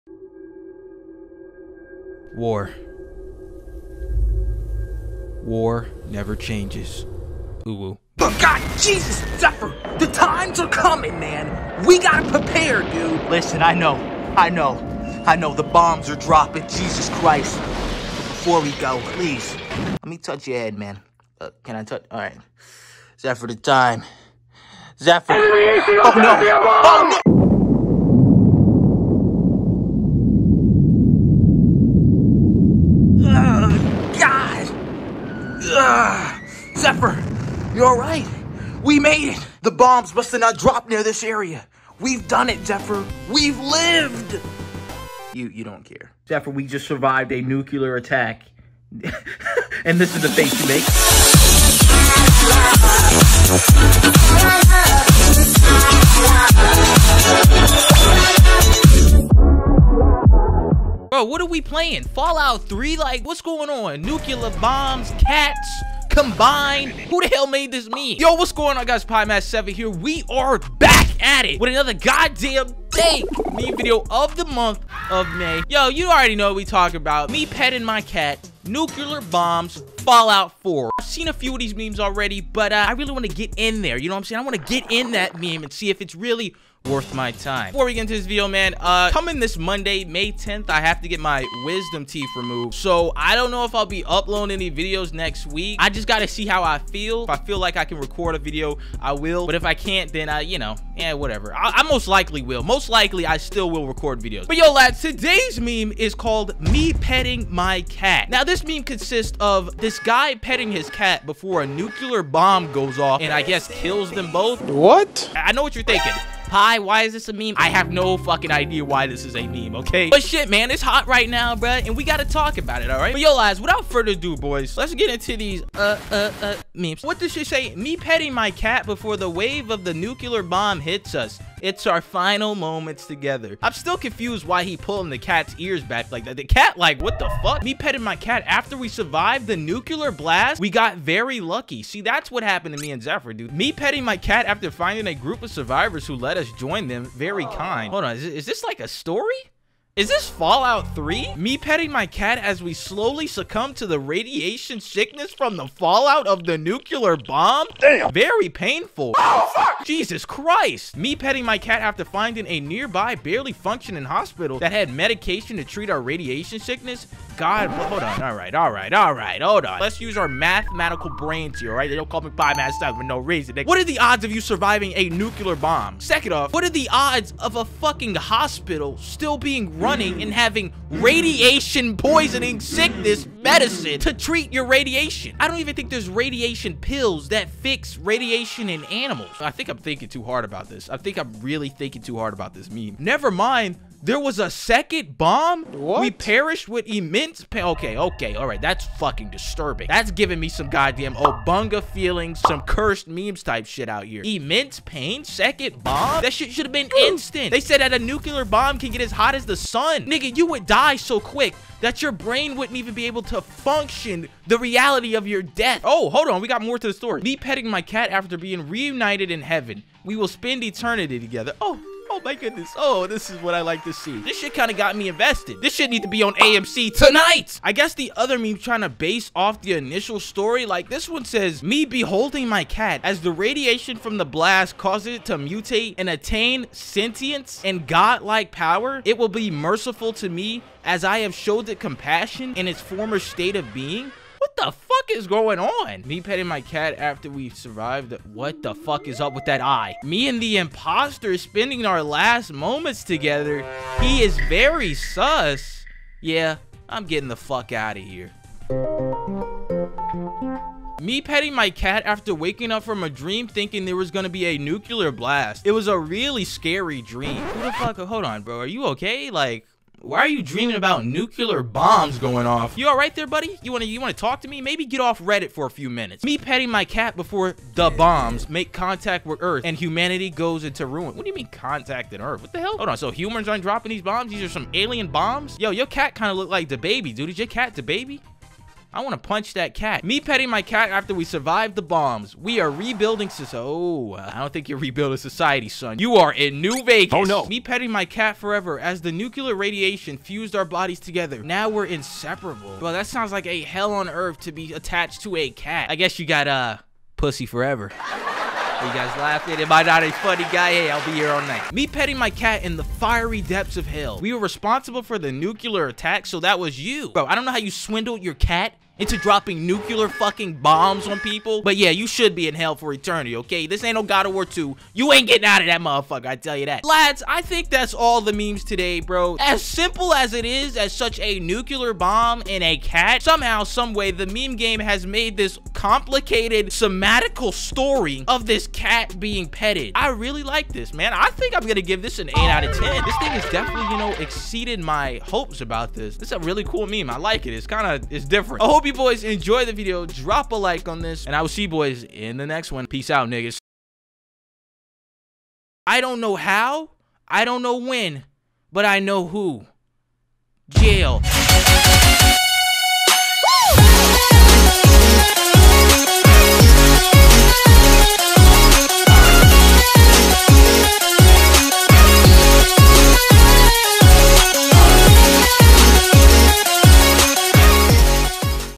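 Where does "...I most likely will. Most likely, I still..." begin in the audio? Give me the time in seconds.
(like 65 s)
101 s.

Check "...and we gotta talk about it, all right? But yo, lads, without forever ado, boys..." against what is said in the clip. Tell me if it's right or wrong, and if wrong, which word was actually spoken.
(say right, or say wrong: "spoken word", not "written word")
wrong: "further", not "forever".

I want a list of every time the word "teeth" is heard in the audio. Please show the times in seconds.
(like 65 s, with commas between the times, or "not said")
92 s.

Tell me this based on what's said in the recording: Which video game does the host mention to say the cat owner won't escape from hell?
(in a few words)
God of War 2.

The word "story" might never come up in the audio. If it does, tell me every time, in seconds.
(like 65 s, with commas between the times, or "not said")
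148 s, 216 s, 230 s, 337 s.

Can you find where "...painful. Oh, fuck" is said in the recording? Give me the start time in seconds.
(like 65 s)
158 s.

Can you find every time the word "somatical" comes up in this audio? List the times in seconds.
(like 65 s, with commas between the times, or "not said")
336 s.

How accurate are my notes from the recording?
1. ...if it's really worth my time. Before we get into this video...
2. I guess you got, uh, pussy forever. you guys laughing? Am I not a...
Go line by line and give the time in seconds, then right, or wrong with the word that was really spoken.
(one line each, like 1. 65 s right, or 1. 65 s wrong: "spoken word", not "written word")
1. 85 s right
2. 305 s right.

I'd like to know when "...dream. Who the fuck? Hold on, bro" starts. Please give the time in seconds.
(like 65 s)
267 s.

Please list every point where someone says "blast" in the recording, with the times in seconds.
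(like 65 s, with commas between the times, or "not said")
140 s, 234 s, 265 s.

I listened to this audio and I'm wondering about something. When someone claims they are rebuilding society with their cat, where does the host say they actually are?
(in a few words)
New Vegas.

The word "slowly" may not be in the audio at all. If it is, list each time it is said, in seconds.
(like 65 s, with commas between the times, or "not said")
152 s.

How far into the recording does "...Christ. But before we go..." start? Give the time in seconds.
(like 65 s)
17 s.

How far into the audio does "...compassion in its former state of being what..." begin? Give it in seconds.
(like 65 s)
241 s.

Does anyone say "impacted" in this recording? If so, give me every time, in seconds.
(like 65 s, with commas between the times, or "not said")
not said.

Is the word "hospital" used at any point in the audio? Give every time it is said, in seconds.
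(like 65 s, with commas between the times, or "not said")
164 s, 178 s.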